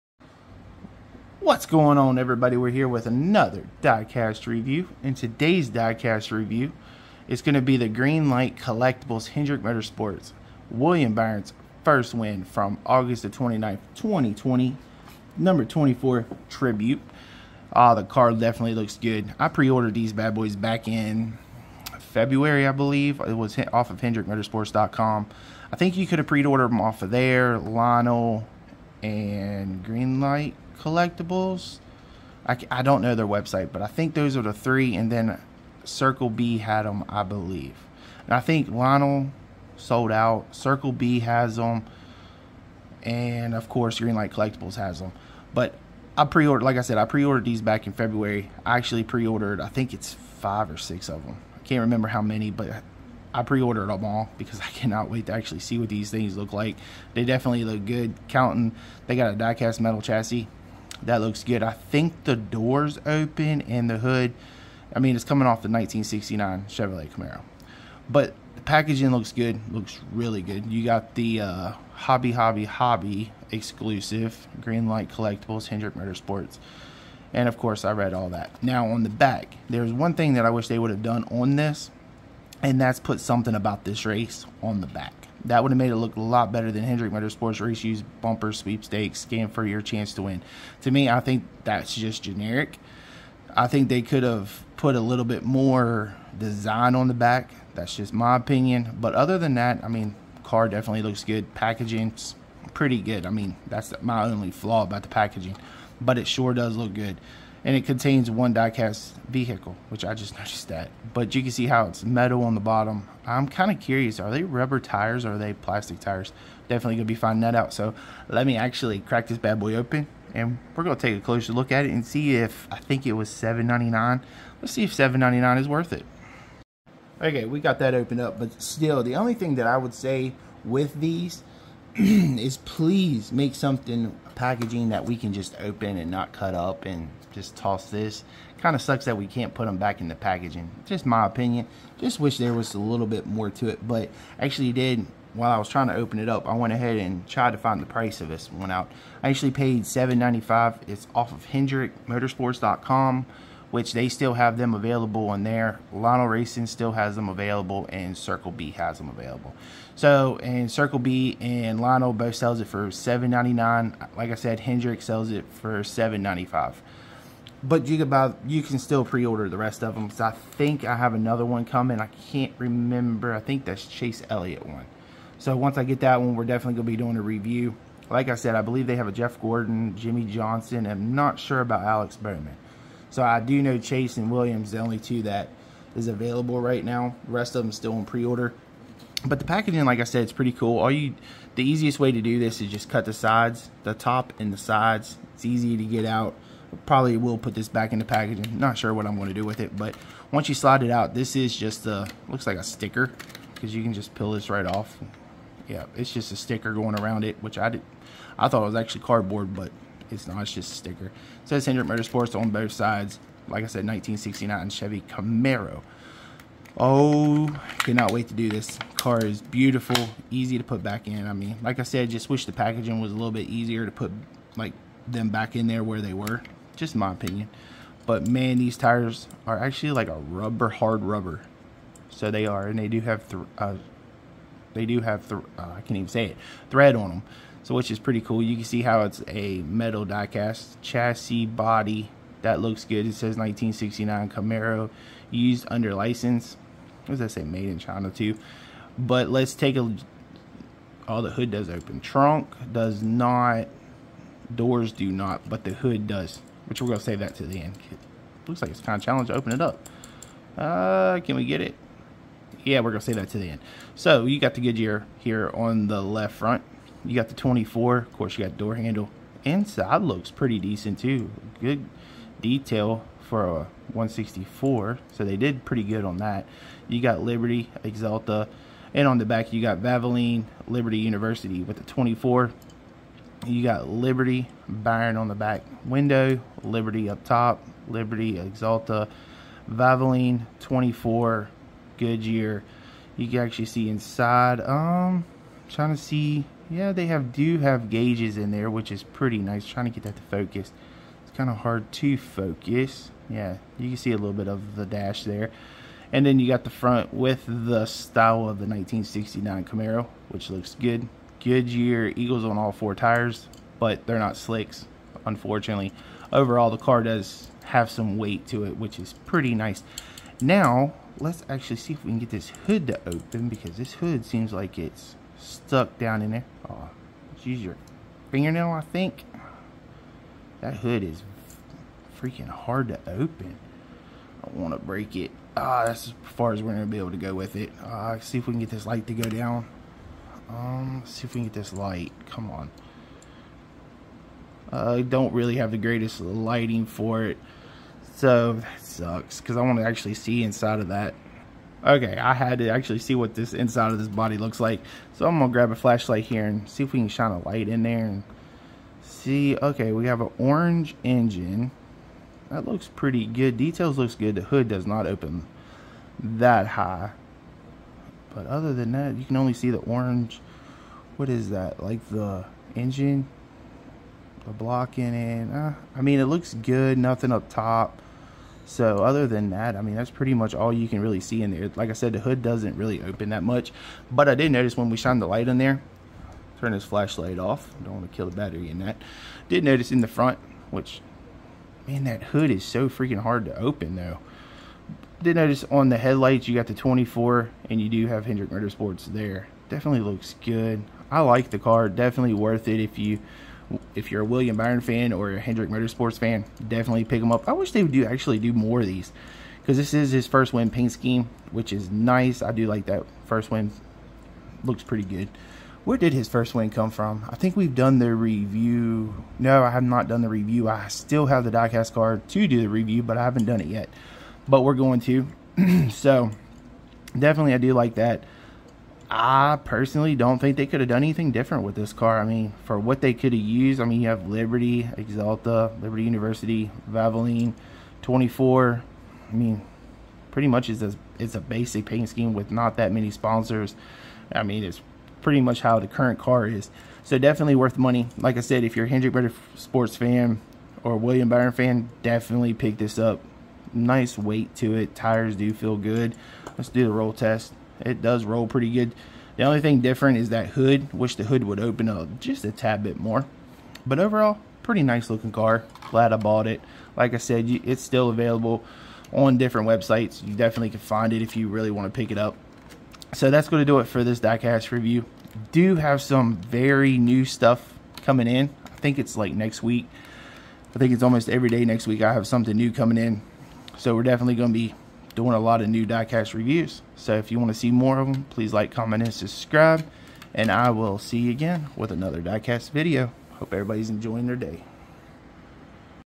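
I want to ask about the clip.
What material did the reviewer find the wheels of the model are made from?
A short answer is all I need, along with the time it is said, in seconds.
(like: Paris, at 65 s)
hard rubber, at 230 s.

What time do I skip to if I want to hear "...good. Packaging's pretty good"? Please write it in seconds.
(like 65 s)
101 s.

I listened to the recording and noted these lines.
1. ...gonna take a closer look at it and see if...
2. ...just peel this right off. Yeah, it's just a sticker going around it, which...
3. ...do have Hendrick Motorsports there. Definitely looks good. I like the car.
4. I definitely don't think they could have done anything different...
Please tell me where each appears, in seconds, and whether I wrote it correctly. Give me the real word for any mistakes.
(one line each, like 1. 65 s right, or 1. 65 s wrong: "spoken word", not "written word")
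1. 120 s right
2. 203 s right
3. 397 s right
4. 429 s wrong: "personally", not "definitely".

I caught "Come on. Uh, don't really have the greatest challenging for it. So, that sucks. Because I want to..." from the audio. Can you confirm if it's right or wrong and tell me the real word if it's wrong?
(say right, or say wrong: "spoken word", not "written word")
wrong: "lighting", not "challenging".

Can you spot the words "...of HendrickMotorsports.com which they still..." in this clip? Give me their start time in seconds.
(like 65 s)
151 s.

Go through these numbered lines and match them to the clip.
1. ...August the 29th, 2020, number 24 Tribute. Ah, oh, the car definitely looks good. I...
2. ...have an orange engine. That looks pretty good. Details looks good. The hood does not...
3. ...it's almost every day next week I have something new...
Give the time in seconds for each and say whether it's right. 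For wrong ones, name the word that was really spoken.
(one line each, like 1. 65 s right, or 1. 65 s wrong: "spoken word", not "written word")
1. 12 s right
2. 360 s right
3. 480 s right.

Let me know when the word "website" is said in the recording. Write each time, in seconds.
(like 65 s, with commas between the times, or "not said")
33 s, 469 s.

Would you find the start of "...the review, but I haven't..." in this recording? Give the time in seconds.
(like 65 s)
422 s.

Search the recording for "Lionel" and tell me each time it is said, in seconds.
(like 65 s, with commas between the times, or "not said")
27 s, 38 s, 155 s, 161 s.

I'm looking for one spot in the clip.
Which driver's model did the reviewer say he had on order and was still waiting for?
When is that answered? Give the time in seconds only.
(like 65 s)
173 s.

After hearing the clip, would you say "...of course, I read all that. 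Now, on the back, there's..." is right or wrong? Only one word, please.
right.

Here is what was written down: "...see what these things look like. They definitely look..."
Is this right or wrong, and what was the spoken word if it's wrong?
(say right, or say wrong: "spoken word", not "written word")
right.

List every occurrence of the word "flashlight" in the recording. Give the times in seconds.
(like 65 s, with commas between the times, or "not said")
355 s, 386 s.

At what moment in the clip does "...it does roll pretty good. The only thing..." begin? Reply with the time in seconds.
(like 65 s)
457 s.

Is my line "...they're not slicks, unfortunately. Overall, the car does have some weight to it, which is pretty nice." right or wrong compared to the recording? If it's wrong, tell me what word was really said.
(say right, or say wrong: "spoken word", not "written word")
right.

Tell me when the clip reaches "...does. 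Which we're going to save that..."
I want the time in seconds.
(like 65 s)
256 s.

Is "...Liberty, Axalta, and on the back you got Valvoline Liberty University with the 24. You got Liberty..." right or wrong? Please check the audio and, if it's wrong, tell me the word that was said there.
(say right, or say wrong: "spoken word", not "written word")
right.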